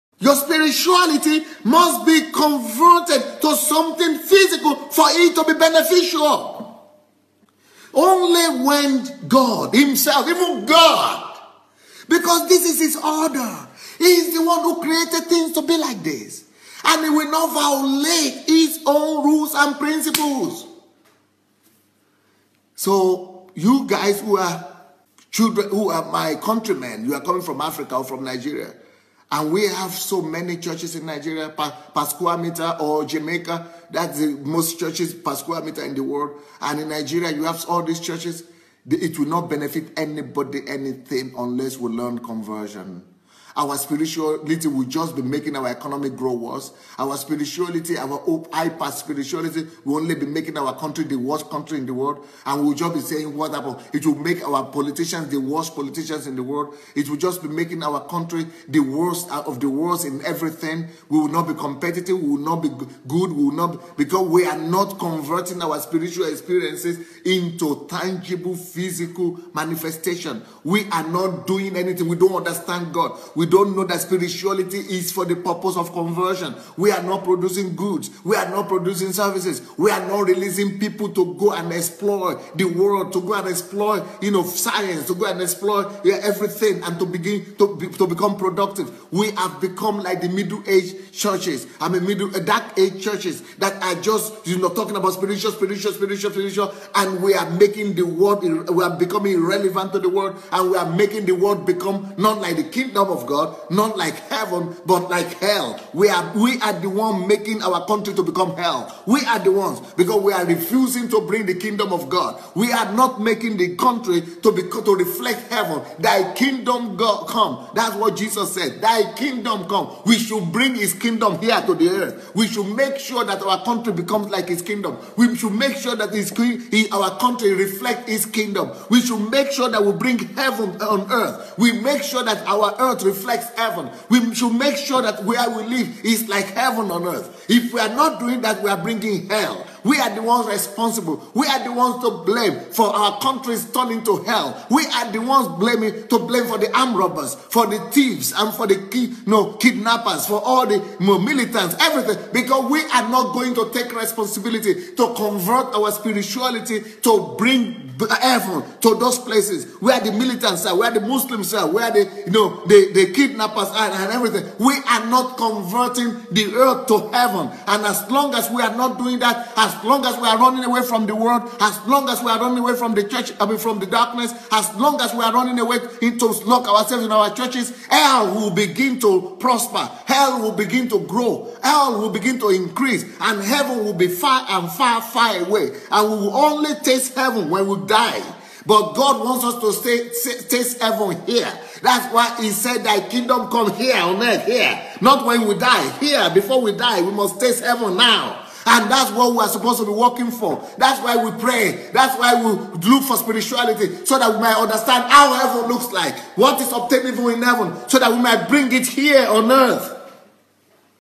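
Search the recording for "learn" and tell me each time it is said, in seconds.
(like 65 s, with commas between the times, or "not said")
41 s.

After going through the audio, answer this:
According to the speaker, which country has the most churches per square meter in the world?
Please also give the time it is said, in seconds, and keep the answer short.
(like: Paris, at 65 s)
Jamaica, at 33 s.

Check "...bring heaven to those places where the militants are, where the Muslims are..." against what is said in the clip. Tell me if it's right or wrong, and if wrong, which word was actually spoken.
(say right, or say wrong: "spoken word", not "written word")
right.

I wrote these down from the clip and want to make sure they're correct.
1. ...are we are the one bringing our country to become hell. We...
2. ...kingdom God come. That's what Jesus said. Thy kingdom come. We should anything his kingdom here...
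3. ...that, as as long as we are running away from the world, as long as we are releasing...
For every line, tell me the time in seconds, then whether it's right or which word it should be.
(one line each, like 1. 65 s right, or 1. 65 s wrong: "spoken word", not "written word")
1. 106 s wrong: "making", not "bringing"
2. 116 s wrong: "bring", not "anything"
3. 169 s wrong: "running", not "releasing".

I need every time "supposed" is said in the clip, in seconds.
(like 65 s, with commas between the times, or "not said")
199 s.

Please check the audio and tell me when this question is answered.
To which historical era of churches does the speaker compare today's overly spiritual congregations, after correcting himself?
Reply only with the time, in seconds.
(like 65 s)
92 s.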